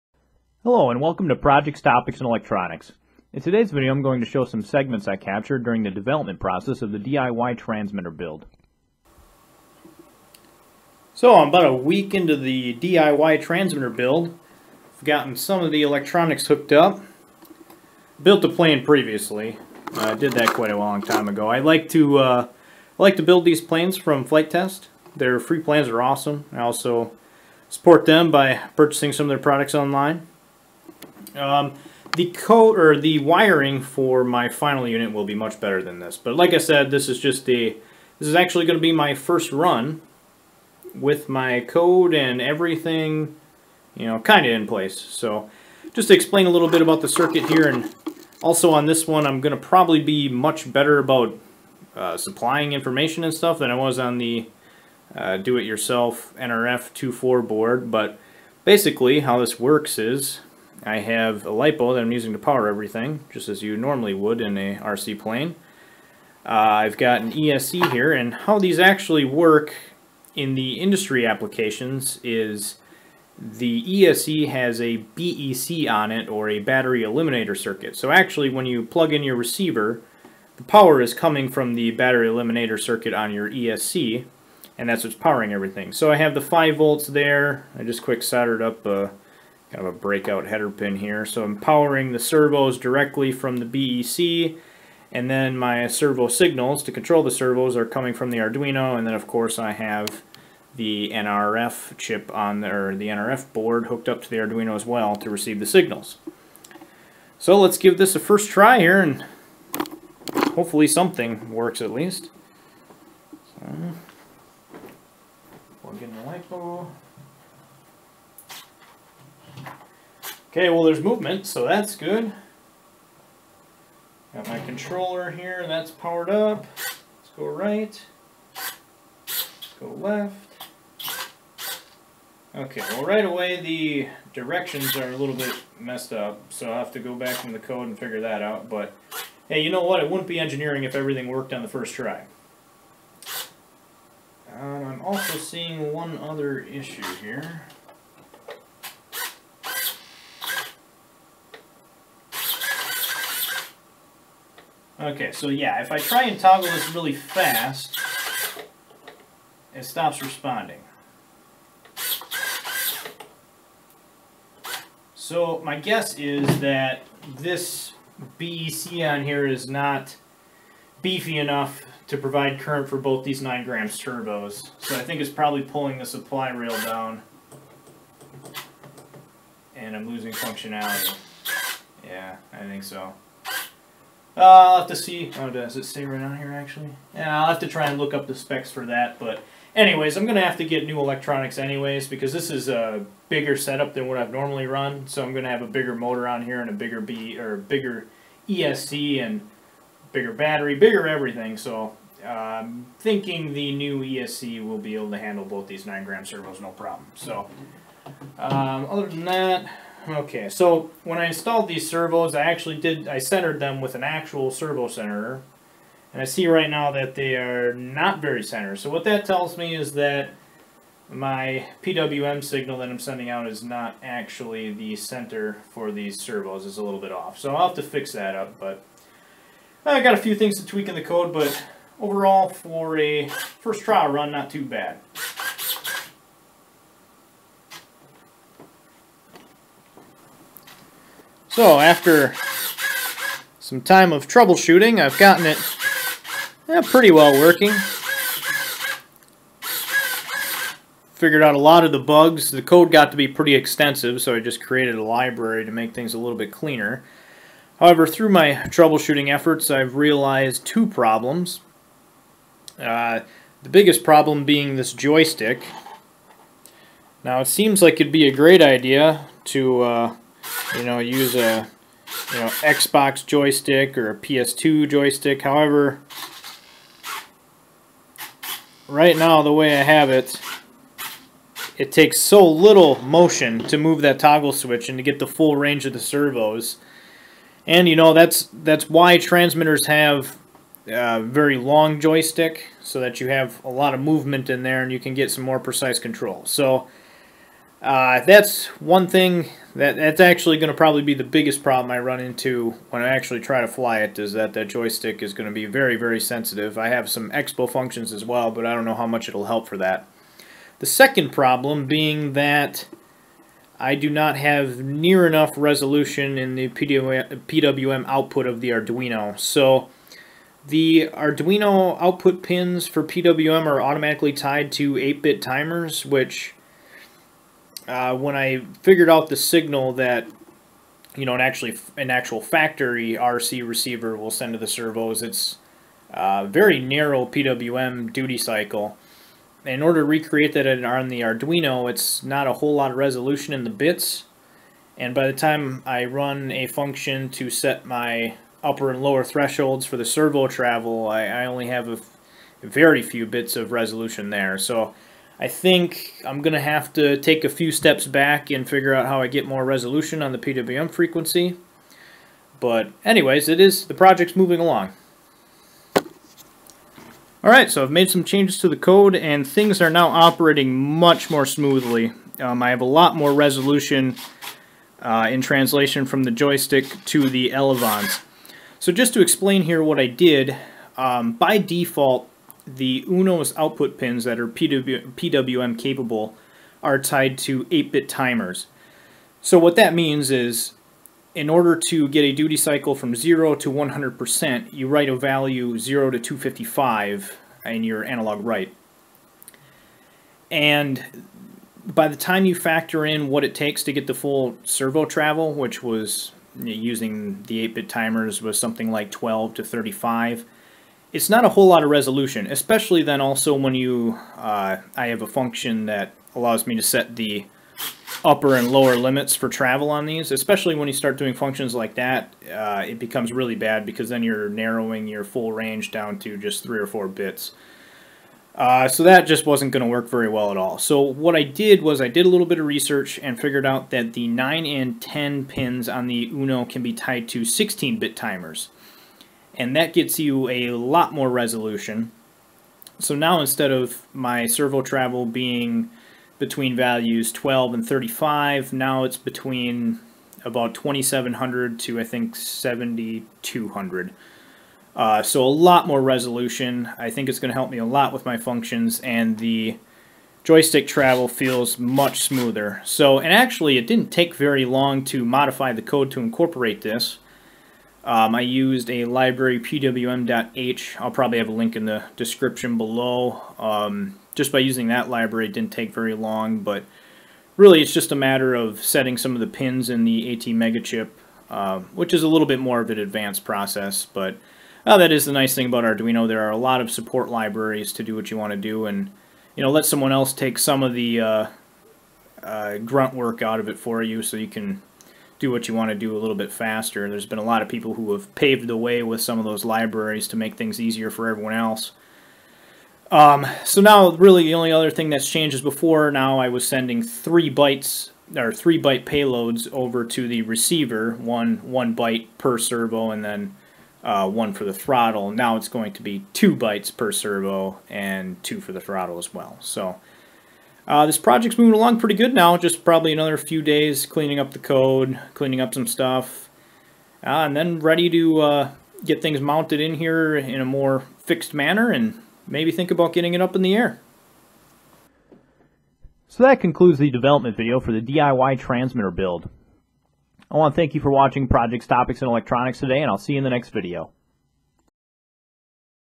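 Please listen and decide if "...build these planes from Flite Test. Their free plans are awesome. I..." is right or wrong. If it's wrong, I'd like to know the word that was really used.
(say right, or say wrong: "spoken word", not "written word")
right.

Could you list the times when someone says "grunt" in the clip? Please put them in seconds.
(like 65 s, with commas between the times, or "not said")
492 s.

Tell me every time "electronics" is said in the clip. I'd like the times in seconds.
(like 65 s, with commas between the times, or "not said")
2 s, 15 s, 190 s, 542 s.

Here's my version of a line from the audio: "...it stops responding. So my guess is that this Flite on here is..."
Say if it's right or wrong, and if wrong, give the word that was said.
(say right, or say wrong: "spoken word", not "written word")
wrong: "BEC", not "Flite".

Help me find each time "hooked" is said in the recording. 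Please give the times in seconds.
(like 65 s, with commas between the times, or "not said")
16 s, 103 s.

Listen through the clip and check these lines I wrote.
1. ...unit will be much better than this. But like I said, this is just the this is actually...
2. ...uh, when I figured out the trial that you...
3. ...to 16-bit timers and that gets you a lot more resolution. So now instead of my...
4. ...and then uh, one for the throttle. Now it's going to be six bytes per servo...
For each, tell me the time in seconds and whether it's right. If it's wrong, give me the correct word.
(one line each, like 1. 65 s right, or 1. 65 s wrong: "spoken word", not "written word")
1. 34 s right
2. 327 s wrong: "signal", not "trial"
3. 437 s right
4. 513 s wrong: "two", not "six".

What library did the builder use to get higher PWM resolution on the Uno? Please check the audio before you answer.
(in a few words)
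pwm.h.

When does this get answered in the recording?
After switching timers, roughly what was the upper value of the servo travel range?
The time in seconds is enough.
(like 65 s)
452 s.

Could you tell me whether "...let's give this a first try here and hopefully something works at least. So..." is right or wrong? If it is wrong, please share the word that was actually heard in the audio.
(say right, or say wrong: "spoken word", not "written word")
right.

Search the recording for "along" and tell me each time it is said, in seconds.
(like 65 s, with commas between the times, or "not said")
364 s, 521 s.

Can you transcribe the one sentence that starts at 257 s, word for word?
However, through my troubleshooting efforts, I've realized two problems.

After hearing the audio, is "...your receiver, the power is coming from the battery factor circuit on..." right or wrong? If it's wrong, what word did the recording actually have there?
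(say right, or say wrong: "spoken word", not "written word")
wrong: "eliminator", not "factor".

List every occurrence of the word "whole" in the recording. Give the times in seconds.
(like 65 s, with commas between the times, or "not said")
342 s, 411 s.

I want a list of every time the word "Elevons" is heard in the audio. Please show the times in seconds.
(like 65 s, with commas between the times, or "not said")
377 s.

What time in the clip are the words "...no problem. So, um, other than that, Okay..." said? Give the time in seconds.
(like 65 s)
206 s.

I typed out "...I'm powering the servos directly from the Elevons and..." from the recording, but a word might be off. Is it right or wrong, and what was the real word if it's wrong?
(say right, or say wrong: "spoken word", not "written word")
wrong: "BEC", not "Elevons".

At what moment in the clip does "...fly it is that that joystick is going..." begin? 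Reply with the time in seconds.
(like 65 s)
303 s.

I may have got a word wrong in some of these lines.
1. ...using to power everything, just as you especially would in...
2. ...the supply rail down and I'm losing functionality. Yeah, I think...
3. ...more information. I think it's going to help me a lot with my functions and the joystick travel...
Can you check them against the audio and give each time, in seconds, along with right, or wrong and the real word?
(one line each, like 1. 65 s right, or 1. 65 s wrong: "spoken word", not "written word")
1. 62 s wrong: "normally", not "especially"
2. 175 s right
3. 455 s wrong: "resolution", not "information".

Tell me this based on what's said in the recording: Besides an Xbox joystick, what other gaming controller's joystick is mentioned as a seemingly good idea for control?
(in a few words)
PS2.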